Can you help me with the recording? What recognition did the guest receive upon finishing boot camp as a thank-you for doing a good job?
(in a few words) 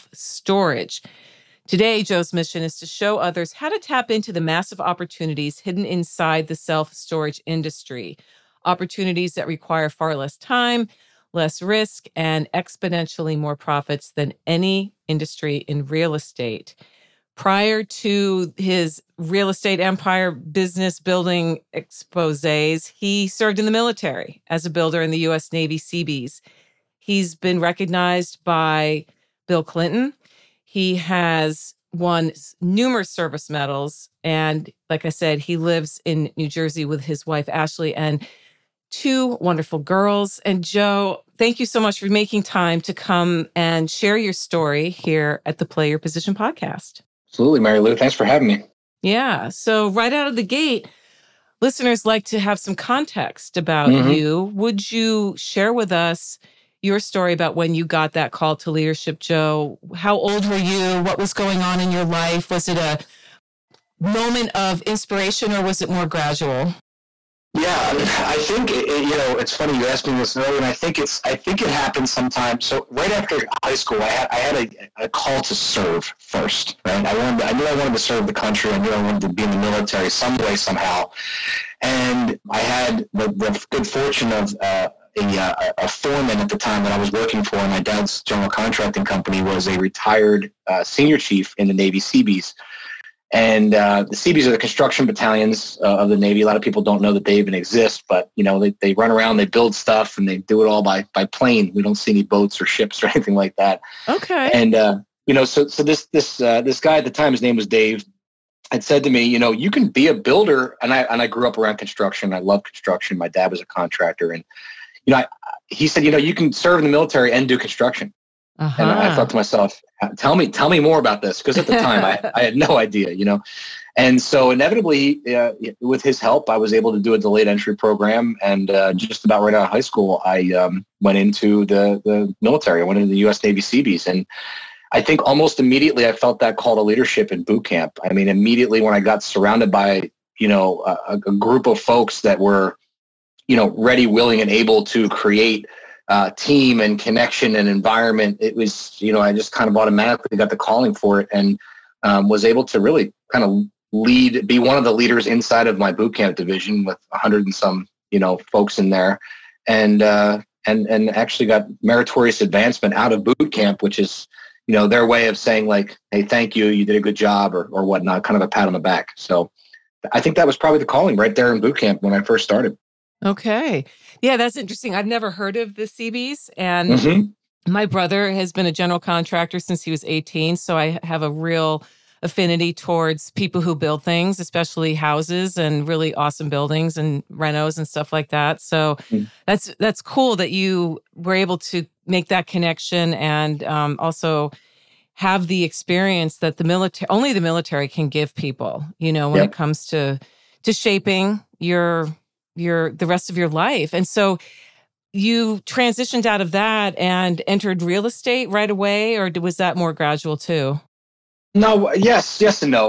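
meritorious advancement.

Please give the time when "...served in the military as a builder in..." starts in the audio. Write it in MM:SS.
00:23.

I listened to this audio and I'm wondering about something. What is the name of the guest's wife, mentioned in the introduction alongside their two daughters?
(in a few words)
Ashley.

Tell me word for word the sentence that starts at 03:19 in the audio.
it comes to to shaping your your the rest of your life.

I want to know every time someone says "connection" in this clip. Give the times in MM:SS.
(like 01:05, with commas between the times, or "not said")
02:26, 03:12.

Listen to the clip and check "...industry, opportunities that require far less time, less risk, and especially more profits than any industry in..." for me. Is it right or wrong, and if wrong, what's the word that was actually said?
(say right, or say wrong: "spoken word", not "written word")
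wrong: "exponentially", not "especially".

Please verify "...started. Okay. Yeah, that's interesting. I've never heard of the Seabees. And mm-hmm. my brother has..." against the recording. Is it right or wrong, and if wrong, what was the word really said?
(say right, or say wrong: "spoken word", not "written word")
right.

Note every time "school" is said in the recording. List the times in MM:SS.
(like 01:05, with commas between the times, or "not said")
01:13, 02:09.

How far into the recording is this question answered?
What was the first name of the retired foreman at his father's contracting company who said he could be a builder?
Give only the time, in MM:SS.
01:47.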